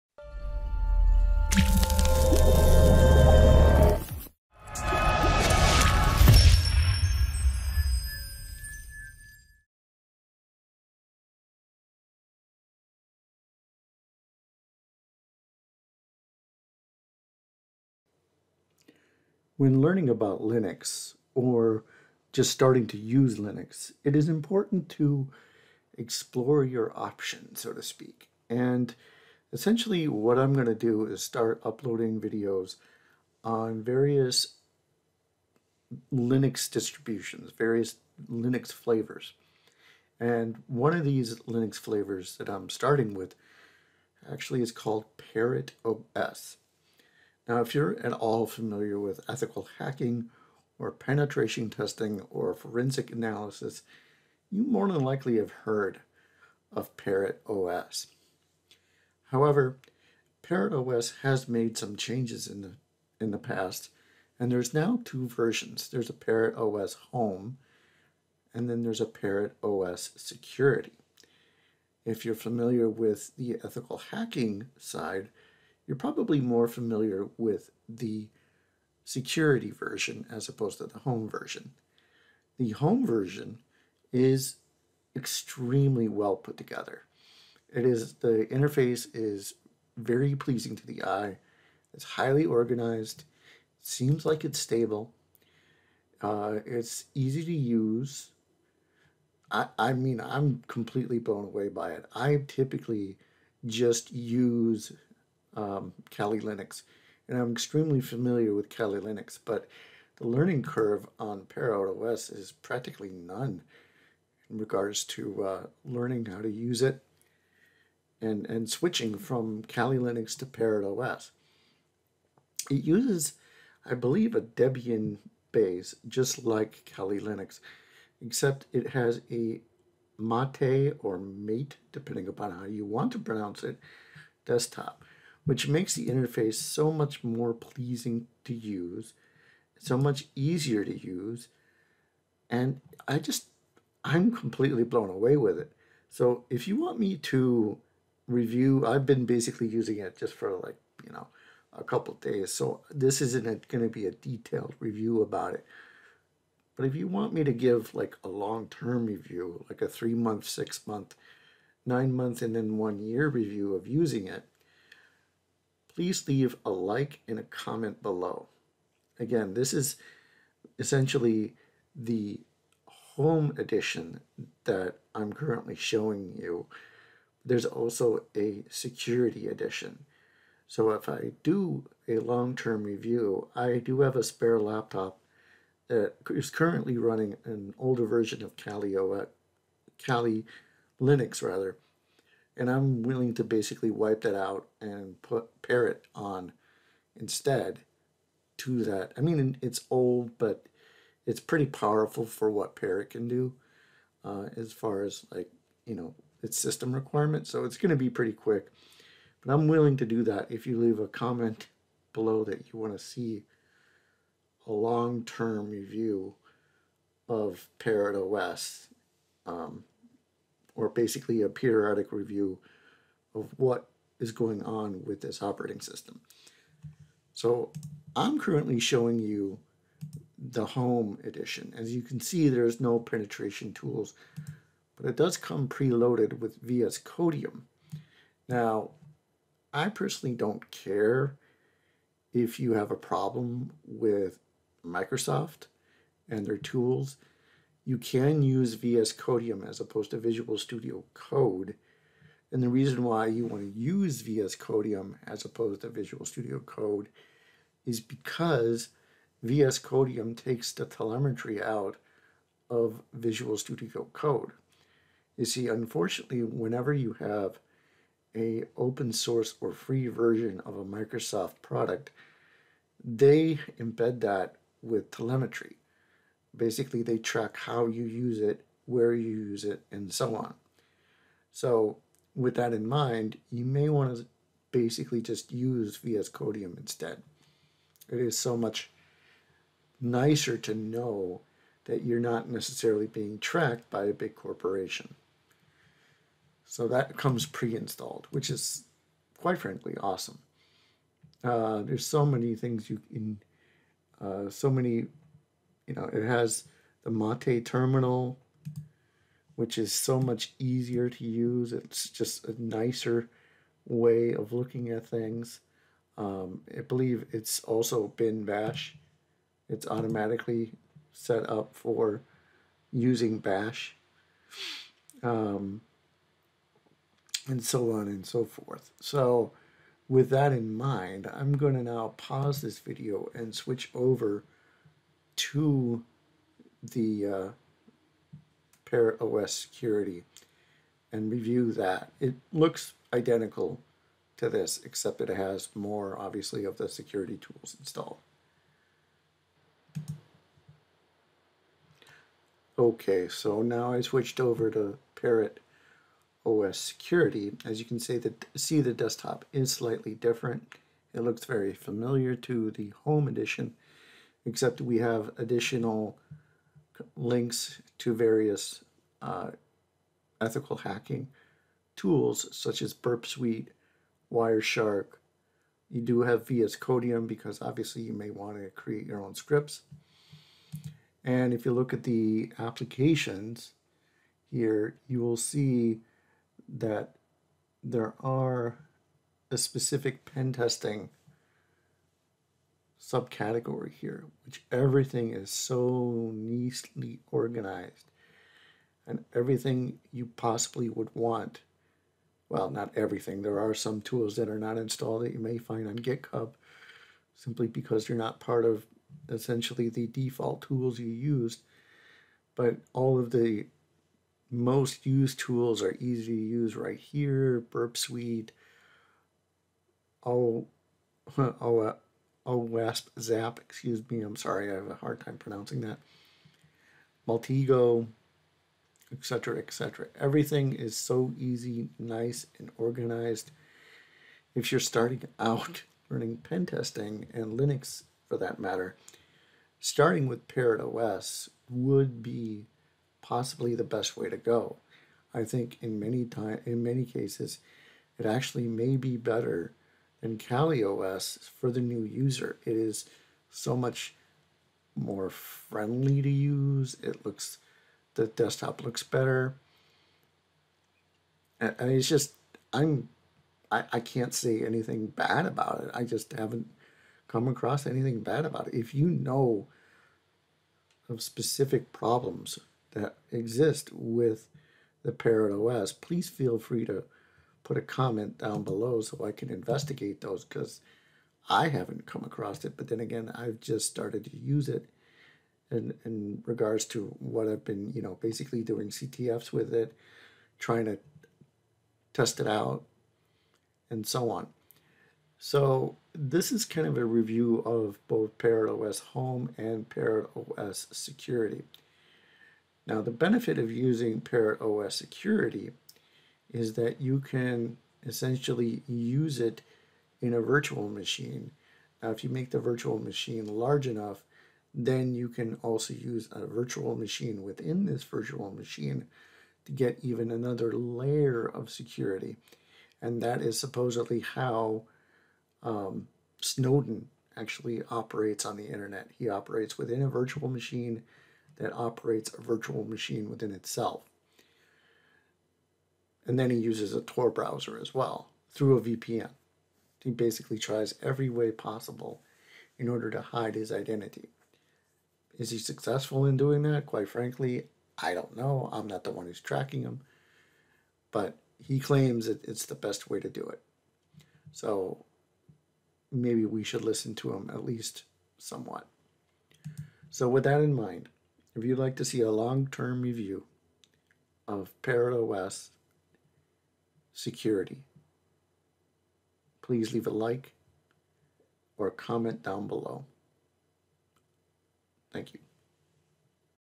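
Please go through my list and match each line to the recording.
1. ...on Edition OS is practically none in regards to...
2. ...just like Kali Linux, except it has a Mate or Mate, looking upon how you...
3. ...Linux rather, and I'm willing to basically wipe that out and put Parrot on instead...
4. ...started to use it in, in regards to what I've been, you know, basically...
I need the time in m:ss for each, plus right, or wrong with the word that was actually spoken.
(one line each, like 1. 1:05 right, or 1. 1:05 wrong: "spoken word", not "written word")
1. 1:51 wrong: "Parrot", not "Edition"
2. 2:06 wrong: "depending", not "looking"
3. 3:11 right
4. 8:03 right.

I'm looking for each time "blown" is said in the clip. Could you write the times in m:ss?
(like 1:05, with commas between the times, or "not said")
1:41, 2:24.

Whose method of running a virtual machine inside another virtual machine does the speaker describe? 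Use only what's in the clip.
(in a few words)
Snowden.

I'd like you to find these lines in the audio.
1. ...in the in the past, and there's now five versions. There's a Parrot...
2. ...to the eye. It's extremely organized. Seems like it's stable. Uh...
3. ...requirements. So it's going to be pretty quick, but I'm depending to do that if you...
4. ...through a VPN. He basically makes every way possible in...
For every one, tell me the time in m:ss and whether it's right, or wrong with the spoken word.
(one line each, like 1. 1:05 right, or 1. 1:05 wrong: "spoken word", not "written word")
1. 1:02 wrong: "two", not "five"
2. 1:30 wrong: "highly", not "extremely"
3. 3:26 wrong: "willing", not "depending"
4. 8:58 wrong: "tries", not "makes".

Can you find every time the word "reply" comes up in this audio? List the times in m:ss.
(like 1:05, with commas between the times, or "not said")
not said.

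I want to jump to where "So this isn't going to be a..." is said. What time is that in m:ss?
2:32.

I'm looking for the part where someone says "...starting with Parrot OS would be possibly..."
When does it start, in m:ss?
7:19.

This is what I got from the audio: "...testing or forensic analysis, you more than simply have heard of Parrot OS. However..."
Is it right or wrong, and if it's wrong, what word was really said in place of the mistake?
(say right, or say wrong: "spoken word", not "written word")
wrong: "likely", not "simply".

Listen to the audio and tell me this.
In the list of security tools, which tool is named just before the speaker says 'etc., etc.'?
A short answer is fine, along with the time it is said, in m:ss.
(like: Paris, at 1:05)
Maltego, at 7:07.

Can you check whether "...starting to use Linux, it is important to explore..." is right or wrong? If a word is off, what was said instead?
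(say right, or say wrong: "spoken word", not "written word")
right.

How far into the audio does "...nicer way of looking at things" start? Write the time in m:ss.
5:12.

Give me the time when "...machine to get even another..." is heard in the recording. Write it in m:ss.
8:38.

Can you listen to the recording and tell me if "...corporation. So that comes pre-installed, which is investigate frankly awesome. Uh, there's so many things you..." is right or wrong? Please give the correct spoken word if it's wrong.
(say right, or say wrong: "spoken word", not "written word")
wrong: "quite", not "investigate".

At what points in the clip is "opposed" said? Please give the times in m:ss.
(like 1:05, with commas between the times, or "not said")
1:20, 4:09, 4:15.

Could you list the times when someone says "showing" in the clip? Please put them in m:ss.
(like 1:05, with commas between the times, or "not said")
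2:55, 3:48.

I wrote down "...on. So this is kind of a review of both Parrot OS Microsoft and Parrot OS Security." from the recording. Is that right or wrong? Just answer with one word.
wrong.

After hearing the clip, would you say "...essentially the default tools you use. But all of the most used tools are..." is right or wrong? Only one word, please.
right.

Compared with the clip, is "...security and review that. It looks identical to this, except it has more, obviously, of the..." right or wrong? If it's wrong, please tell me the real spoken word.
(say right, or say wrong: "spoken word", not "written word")
right.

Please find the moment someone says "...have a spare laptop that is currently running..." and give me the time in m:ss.
3:04.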